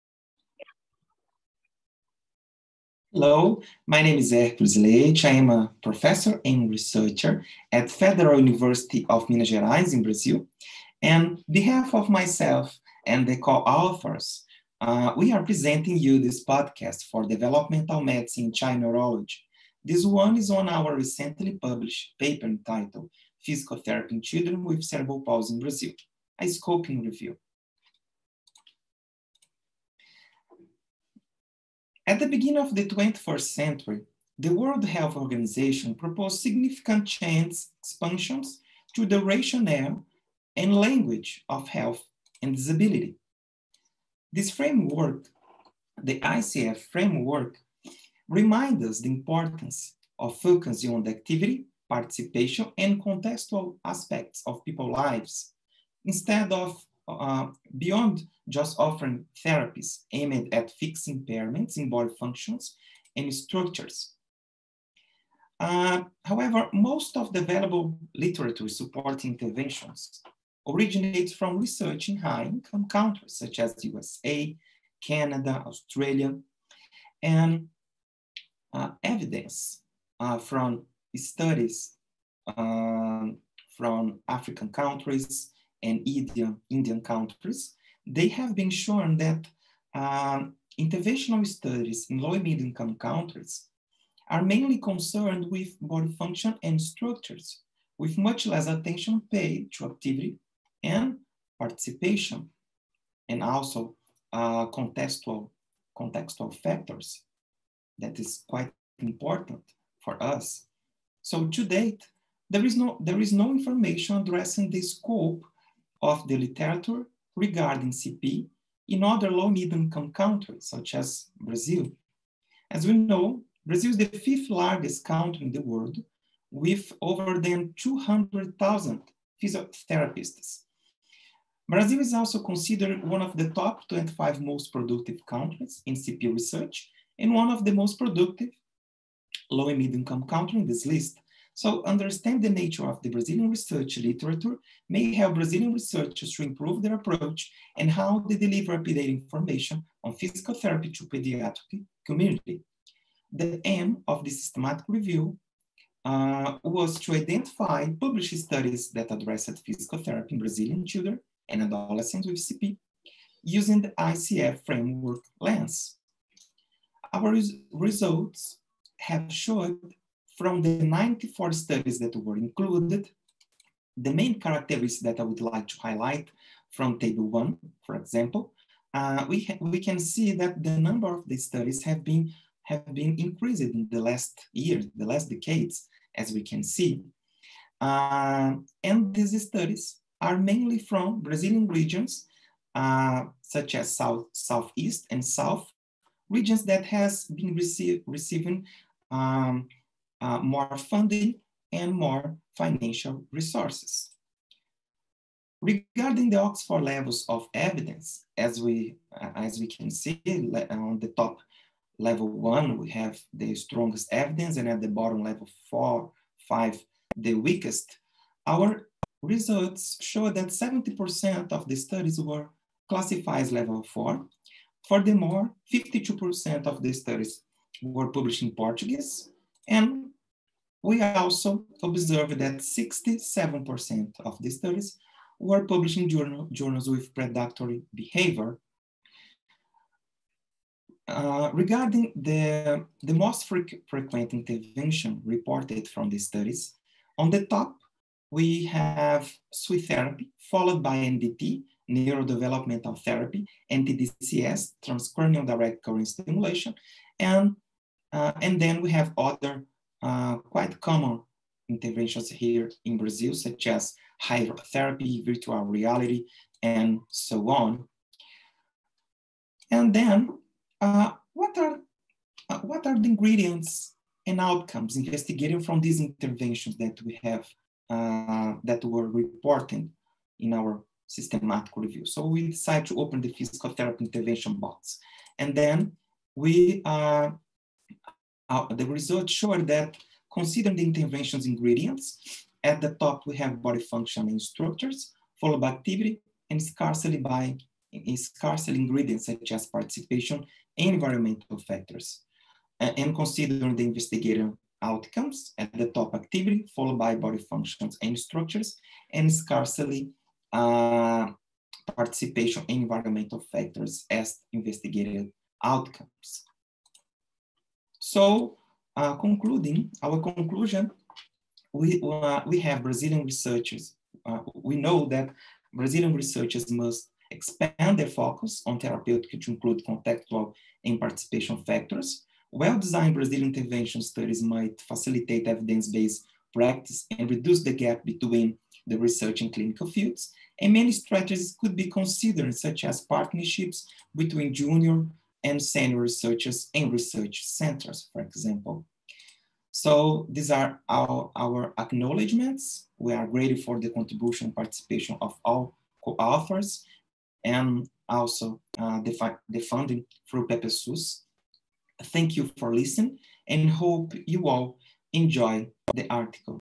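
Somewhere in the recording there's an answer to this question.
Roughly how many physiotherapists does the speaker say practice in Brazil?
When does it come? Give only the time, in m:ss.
2:07.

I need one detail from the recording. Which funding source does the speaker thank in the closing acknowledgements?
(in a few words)
PPSUS.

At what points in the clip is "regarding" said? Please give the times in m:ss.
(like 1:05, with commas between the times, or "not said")
1:57, 3:25, 4:01.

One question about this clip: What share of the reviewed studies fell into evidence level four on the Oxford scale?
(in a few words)
70%.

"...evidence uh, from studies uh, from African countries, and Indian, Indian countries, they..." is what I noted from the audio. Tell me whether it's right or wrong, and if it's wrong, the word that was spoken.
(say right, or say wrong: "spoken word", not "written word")
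right.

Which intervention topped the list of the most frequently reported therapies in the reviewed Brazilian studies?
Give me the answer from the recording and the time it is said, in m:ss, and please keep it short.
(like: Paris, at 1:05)
Suit therapy, at 4:09.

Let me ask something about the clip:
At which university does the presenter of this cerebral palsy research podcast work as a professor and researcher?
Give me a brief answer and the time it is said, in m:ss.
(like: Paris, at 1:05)
Federal University of Minas Gerais, at 0:07.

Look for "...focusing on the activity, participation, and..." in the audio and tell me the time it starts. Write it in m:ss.
0:50.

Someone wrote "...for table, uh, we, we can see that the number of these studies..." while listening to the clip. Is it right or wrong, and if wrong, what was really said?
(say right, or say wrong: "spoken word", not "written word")
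wrong: "example", not "table".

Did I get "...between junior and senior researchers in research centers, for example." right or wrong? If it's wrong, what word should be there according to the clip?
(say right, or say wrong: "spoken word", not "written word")
right.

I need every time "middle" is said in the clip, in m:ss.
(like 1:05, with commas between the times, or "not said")
1:32, 1:59, 2:19.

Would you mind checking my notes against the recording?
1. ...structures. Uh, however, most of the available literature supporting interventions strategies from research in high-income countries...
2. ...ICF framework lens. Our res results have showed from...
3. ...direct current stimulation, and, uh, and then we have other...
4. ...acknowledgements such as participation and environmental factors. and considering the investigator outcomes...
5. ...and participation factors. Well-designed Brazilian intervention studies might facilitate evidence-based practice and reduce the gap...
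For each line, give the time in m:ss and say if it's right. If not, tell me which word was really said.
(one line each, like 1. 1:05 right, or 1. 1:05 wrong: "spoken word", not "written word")
1. 1:03 wrong: "originates", not "strategies"
2. 2:43 right
3. 4:15 right
4. 4:58 wrong: "ingredients", not "acknowledgements"
5. 5:30 right.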